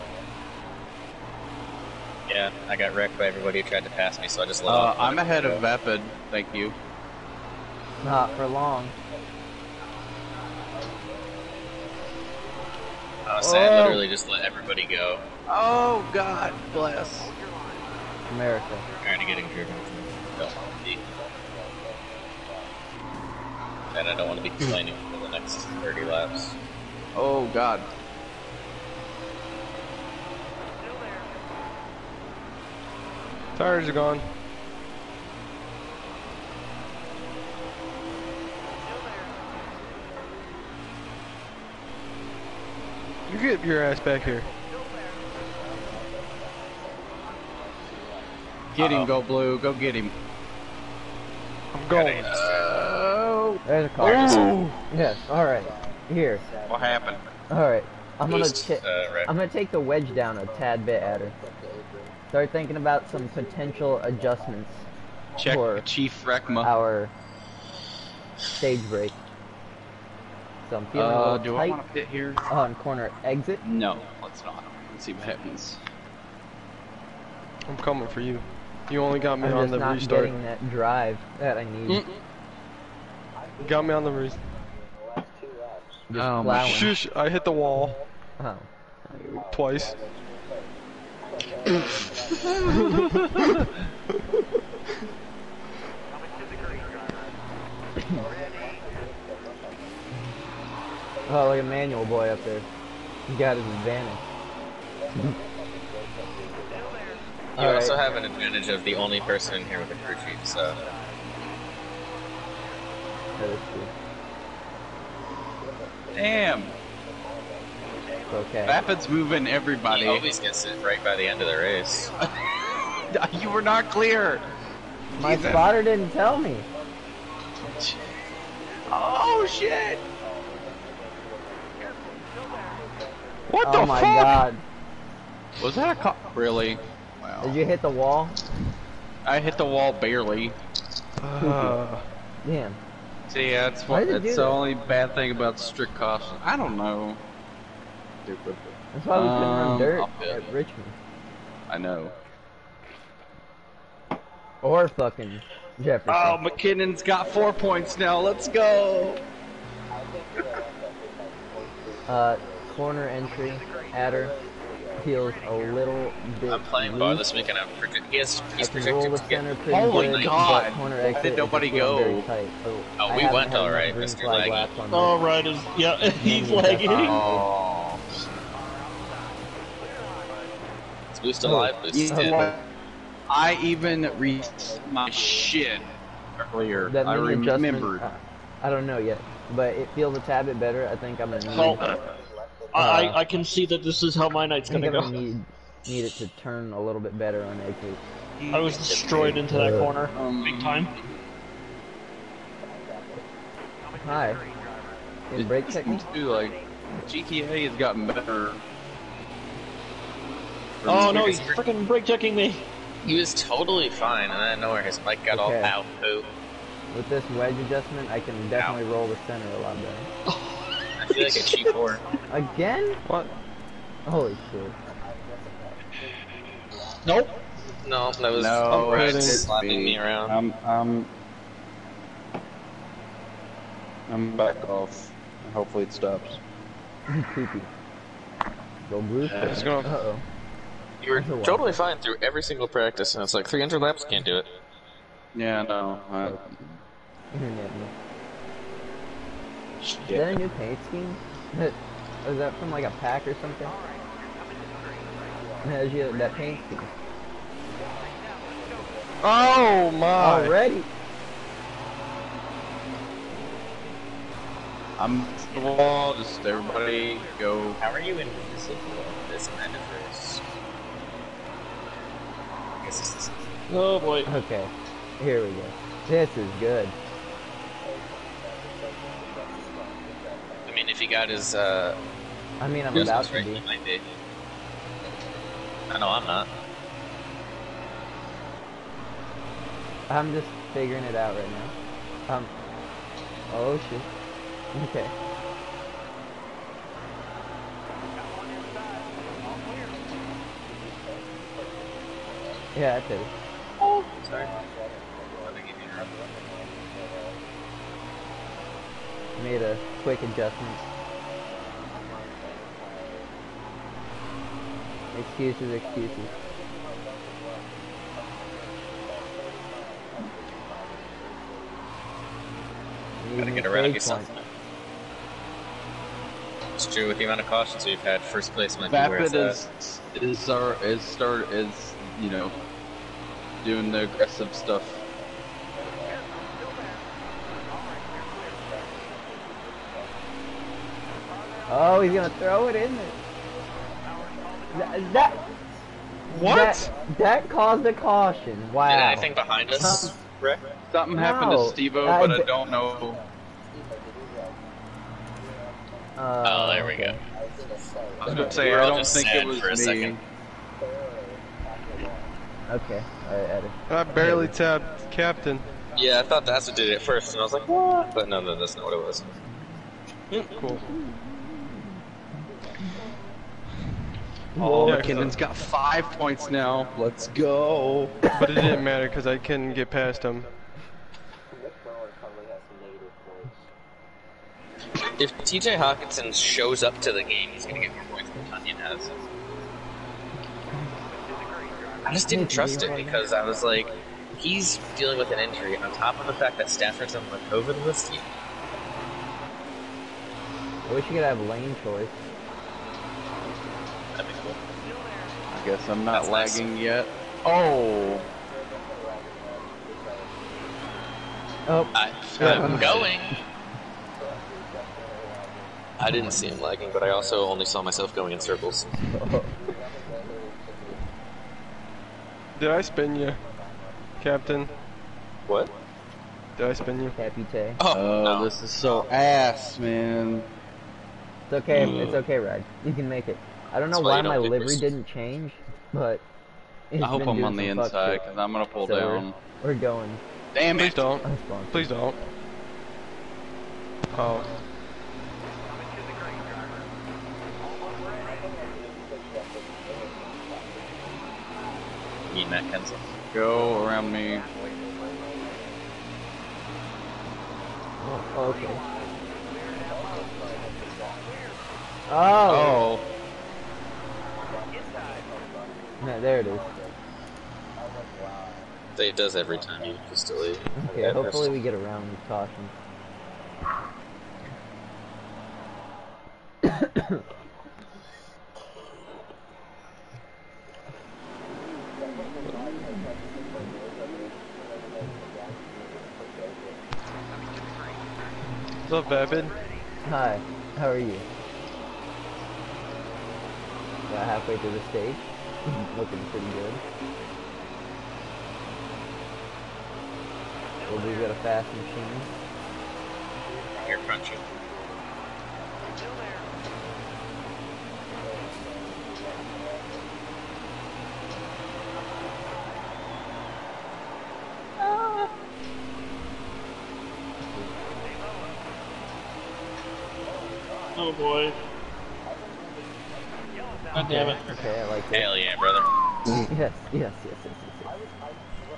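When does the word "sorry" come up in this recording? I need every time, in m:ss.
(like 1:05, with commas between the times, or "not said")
5:04.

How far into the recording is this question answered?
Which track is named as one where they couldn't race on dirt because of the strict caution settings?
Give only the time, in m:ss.
2:30.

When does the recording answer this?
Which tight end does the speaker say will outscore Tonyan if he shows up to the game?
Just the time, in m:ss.
6:25.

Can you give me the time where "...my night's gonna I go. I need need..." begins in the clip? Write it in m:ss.
3:14.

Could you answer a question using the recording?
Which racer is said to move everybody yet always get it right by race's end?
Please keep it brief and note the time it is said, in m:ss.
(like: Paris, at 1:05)
Rapid, at 1:58.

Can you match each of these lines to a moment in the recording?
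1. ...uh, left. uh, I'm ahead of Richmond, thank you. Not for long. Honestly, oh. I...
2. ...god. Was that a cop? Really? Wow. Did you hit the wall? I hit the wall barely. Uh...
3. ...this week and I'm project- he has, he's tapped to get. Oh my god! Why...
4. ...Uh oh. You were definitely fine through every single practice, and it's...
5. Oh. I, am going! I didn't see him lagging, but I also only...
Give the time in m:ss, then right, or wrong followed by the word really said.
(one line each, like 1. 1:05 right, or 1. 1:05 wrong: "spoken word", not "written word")
1. 0:04 wrong: "Vapid", not "Richmond"
2. 2:14 right
3. 2:47 wrong: "projected", not "tapped"
4. 3:59 wrong: "totally", not "definitely"
5. 6:51 right.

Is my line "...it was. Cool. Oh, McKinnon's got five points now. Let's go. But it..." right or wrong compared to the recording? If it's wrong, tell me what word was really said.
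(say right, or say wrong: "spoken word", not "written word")
right.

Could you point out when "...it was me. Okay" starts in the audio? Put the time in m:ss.
5:59.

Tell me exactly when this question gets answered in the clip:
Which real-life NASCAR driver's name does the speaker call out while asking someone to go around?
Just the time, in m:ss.
7:32.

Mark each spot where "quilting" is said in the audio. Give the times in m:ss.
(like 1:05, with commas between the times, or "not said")
not said.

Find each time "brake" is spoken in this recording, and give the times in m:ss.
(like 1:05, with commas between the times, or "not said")
3:25, 3:31.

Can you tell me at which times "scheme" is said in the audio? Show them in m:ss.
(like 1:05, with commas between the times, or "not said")
4:10, 4:16.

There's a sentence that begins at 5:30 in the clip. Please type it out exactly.
is our is start is you know doing the aggressive stuff.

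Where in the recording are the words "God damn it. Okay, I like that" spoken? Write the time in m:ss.
8:43.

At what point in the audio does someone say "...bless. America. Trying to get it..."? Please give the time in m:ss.
0:16.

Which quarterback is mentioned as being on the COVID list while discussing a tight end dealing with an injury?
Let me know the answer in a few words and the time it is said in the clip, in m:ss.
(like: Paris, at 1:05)
Stafford, at 6:36.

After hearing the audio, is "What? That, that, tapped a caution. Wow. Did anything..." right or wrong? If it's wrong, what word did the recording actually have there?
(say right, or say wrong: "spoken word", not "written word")
wrong: "caused", not "tapped".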